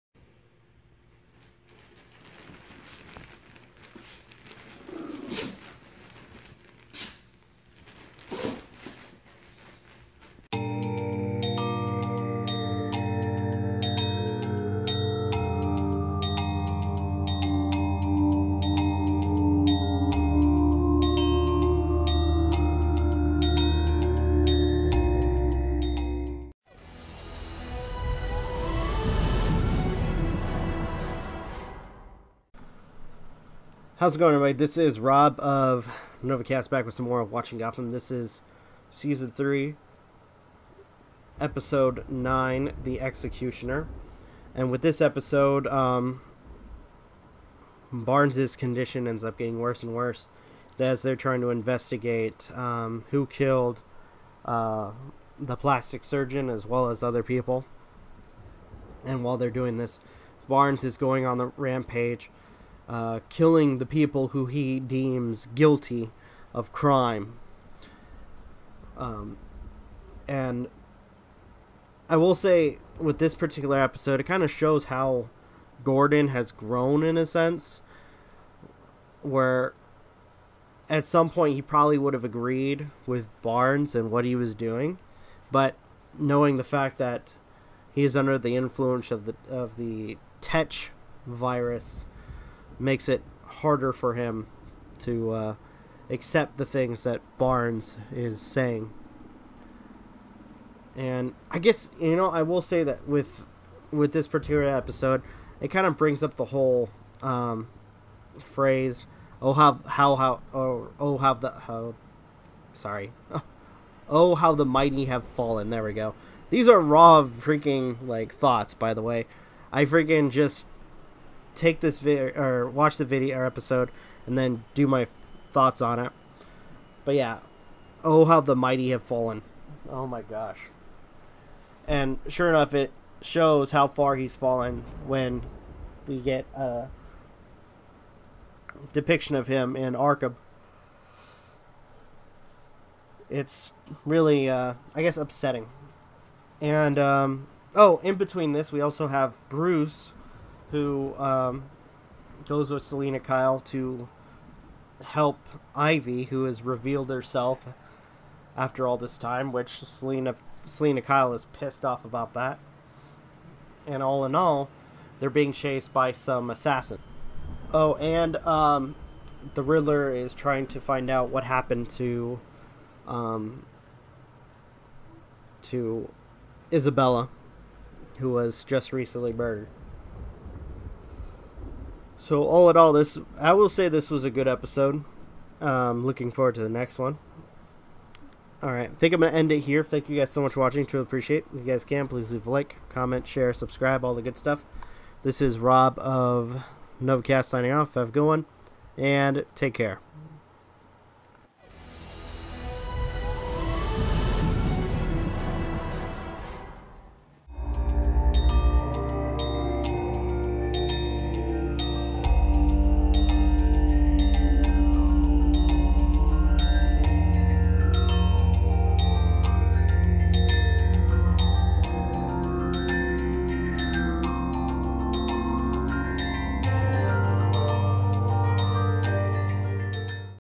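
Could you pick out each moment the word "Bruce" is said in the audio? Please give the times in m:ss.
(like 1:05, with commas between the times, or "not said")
2:29.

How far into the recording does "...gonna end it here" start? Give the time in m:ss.
3:09.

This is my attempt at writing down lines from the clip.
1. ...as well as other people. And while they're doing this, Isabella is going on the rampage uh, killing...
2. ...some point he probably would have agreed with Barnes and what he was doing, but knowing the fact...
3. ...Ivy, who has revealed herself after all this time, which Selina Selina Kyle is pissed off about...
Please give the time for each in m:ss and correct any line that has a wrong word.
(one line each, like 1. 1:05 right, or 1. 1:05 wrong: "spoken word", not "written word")
1. 0:56 wrong: "Barnes", not "Isabella"
2. 1:21 right
3. 2:35 right.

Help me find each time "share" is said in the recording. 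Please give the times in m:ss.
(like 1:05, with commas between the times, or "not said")
3:13.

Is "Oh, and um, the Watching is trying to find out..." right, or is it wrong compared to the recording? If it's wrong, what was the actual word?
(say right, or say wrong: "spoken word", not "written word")
wrong: "Riddler", not "Watching".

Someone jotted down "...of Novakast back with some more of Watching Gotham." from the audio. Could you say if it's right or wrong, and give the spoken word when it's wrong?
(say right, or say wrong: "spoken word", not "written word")
right.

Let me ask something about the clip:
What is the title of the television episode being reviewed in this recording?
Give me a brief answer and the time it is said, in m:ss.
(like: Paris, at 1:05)
The Executioner, at 0:42.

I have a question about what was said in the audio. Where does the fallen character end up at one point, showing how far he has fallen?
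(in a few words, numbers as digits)
Arkham.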